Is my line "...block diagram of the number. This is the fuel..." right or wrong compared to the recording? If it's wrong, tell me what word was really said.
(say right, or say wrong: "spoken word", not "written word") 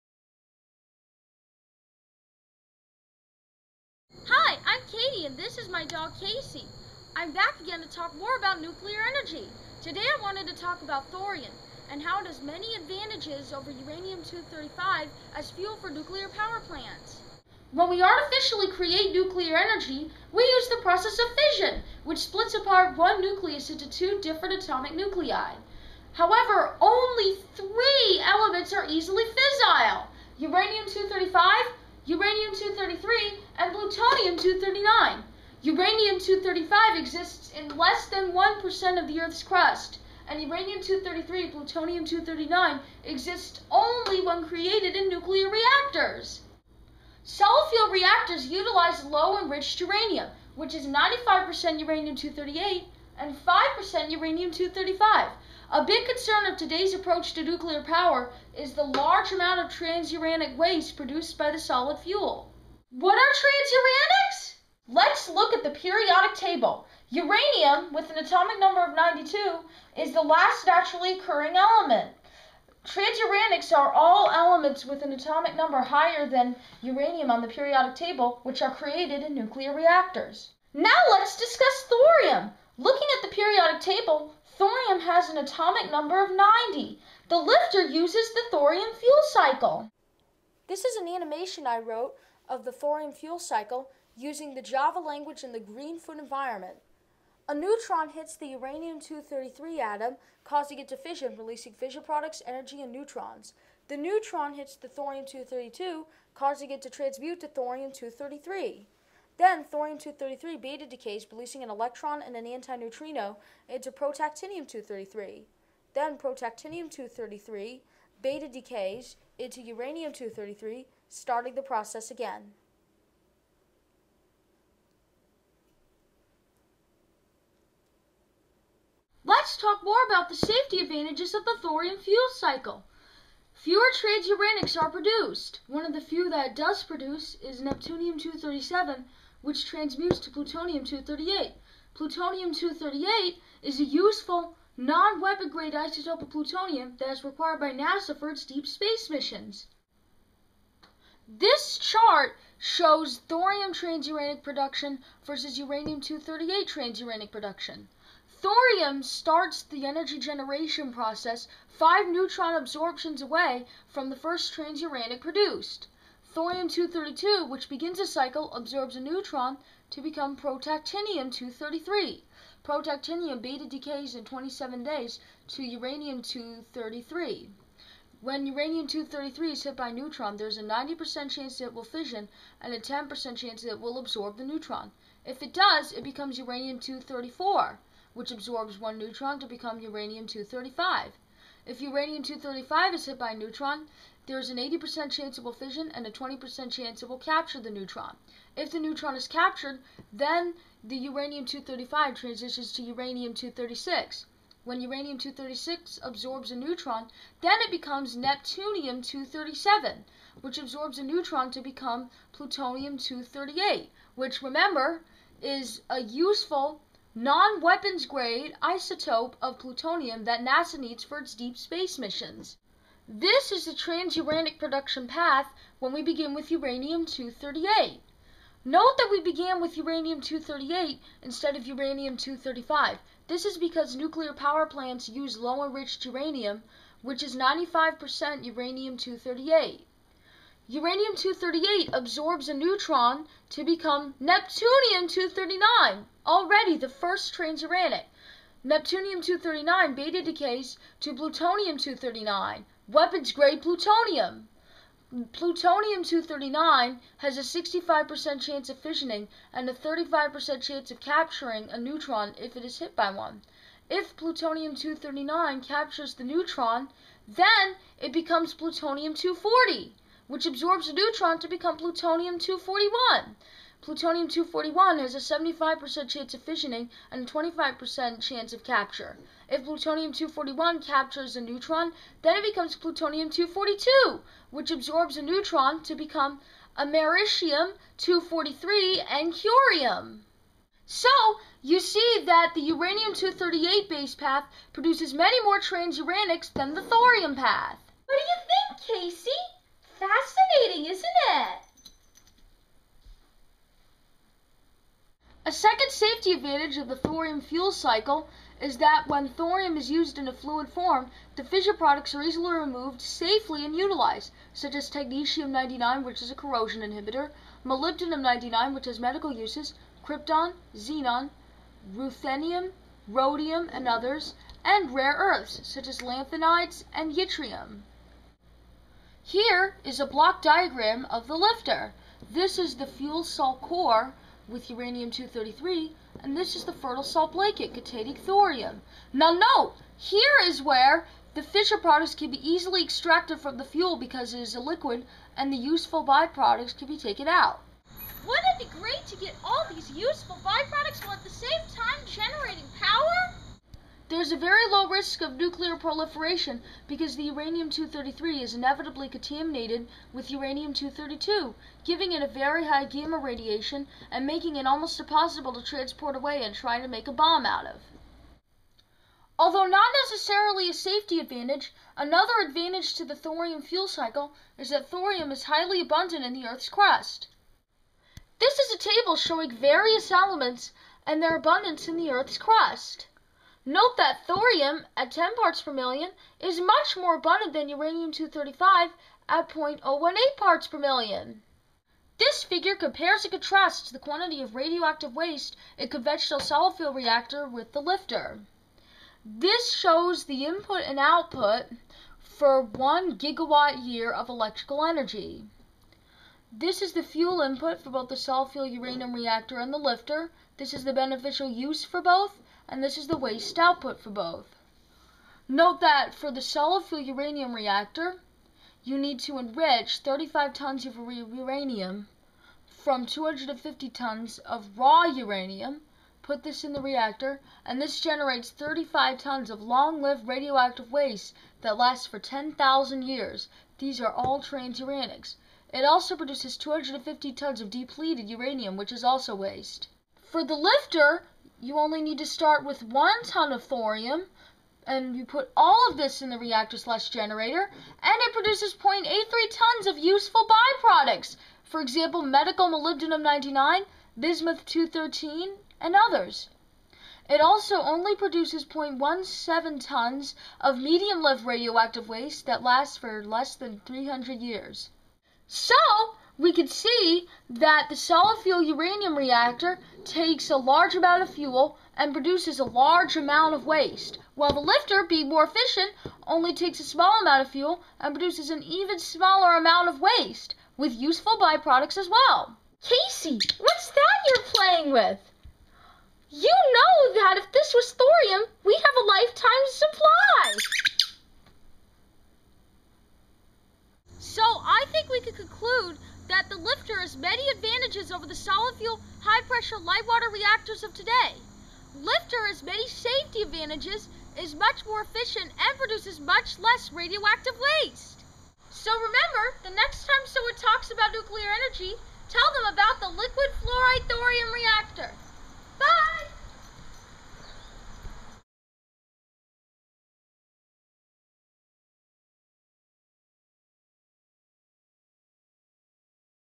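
wrong: "lifter", not "number".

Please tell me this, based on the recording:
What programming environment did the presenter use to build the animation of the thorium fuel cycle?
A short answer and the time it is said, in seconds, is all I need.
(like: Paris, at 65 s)
Greenfoot, at 95 s.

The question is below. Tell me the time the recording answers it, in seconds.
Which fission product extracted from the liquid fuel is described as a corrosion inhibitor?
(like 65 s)
314 s.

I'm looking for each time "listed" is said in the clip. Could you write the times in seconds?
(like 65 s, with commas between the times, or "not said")
not said.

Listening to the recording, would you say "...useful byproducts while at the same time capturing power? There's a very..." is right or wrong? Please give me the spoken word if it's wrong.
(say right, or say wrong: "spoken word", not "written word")
wrong: "generating", not "capturing".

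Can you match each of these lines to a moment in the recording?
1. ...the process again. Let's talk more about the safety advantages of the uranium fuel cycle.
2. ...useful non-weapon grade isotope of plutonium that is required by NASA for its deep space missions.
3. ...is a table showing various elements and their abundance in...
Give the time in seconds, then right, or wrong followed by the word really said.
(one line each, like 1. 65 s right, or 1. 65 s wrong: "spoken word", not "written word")
1. 121 s wrong: "thorium", not "uranium"
2. 143 s right
3. 378 s right.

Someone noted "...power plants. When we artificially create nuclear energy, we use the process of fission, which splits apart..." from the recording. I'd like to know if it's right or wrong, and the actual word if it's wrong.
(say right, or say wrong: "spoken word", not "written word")
right.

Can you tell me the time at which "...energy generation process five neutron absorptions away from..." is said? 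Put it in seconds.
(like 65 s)
159 s.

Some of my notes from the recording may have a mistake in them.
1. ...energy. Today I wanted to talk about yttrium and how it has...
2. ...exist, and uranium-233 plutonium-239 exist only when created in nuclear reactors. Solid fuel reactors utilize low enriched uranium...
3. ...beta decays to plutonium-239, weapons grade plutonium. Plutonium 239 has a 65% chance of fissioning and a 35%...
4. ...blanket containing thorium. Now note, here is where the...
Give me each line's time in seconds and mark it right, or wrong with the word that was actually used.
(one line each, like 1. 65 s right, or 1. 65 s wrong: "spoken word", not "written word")
1. 9 s wrong: "thorium", not "yttrium"
2. 39 s wrong: "crust", not "exist"
3. 249 s right
4. 337 s right.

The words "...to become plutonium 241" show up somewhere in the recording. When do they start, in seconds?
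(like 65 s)
271 s.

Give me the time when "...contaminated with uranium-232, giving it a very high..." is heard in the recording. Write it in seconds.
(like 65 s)
359 s.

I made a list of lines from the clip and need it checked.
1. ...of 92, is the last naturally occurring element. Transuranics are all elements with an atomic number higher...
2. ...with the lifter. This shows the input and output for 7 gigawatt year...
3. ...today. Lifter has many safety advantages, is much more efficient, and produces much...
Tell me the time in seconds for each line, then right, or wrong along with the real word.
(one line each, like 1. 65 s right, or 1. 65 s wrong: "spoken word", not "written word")
1. 68 s right
2. 397 s wrong: "1", not "7"
3. 500 s right.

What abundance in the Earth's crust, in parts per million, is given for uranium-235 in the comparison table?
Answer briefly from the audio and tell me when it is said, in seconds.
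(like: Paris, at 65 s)
0.018 ppm, at 389 s.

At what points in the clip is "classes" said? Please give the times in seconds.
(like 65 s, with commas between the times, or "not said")
not said.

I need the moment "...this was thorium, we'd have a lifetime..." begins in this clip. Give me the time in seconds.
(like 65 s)
487 s.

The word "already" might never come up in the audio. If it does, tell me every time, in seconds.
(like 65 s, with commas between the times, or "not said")
246 s.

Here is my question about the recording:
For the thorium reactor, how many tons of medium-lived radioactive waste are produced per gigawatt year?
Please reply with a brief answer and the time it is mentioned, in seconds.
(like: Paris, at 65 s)
0.17 tons, at 458 s.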